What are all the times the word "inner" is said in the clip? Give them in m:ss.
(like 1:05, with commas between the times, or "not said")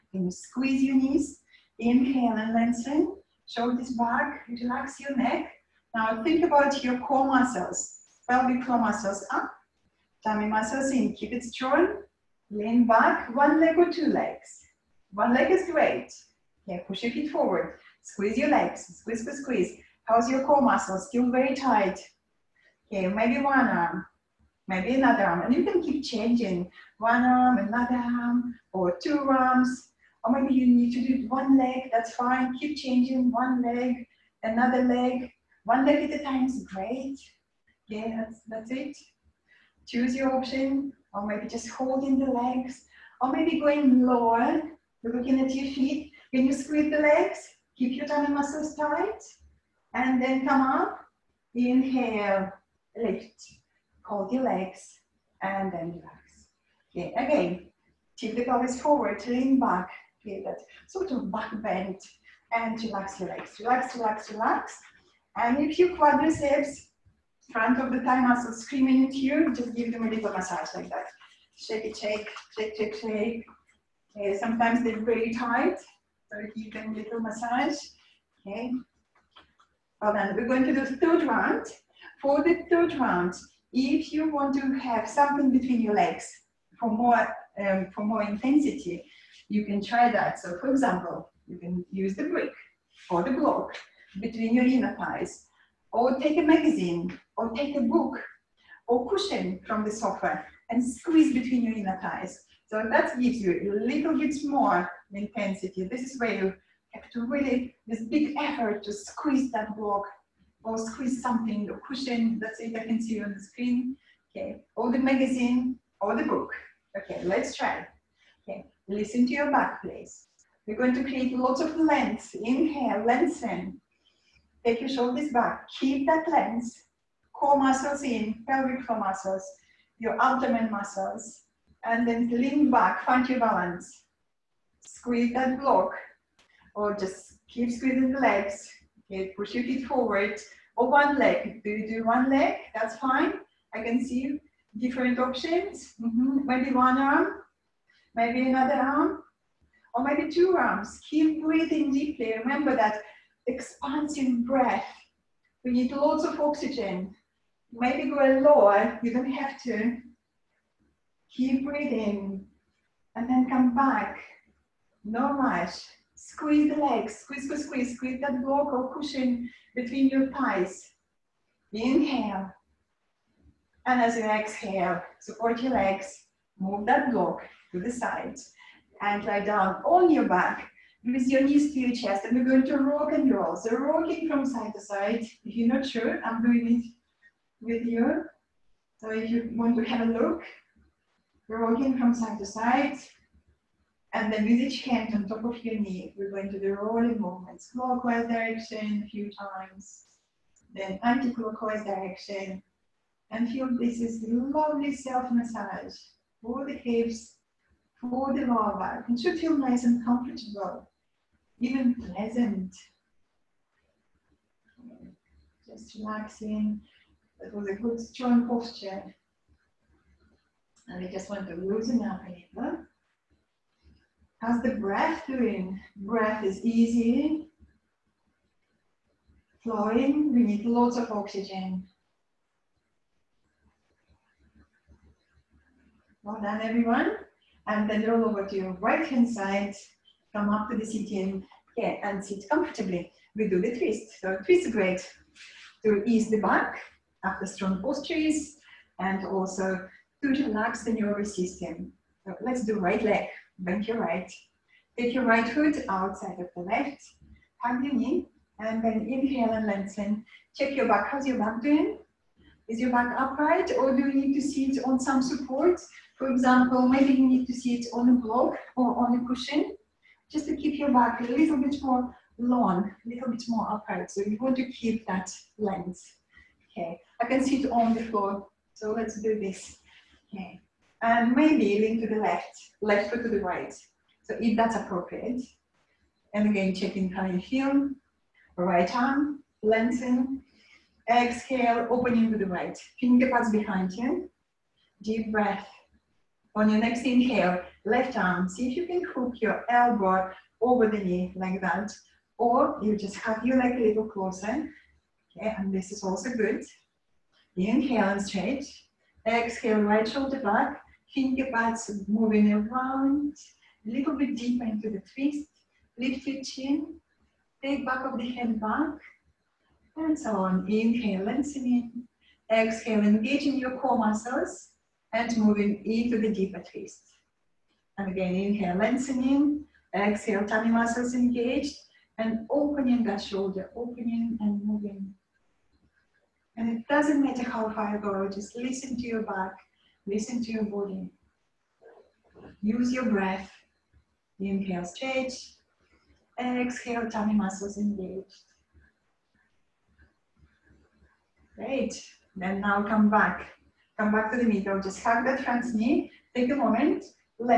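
1:34, 1:41.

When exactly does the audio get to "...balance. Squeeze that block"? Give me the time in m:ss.
2:13.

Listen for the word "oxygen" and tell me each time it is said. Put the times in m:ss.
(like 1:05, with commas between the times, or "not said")
2:36, 3:51.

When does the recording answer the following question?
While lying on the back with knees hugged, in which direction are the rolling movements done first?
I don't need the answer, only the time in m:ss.
3:17.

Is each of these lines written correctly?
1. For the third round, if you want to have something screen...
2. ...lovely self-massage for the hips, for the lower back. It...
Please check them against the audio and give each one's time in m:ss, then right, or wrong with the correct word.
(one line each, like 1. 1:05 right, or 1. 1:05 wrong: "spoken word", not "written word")
1. 1:22 wrong: "between", not "screen"
2. 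3:24 right.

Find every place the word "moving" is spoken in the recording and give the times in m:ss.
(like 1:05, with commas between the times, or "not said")
5:12, 5:25, 5:34.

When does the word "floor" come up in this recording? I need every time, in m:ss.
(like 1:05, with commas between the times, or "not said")
0:08, 2:08, 4:38.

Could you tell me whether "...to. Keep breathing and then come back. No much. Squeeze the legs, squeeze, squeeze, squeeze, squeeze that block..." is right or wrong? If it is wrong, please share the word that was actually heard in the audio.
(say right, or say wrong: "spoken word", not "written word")
right.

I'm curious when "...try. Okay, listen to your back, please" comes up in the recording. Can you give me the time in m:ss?
1:57.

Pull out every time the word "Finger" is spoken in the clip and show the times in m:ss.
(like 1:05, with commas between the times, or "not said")
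4:52.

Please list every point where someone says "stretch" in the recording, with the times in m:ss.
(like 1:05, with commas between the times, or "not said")
5:08, 5:44.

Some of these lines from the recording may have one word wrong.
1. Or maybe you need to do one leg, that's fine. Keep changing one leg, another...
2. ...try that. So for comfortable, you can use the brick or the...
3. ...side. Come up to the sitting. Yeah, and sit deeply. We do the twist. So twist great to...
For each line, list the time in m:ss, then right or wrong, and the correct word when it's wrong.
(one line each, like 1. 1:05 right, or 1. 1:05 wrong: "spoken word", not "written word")
1. 0:30 right
2. 1:29 wrong: "example", not "comfortable"
3. 3:59 wrong: "comfortably", not "deeply".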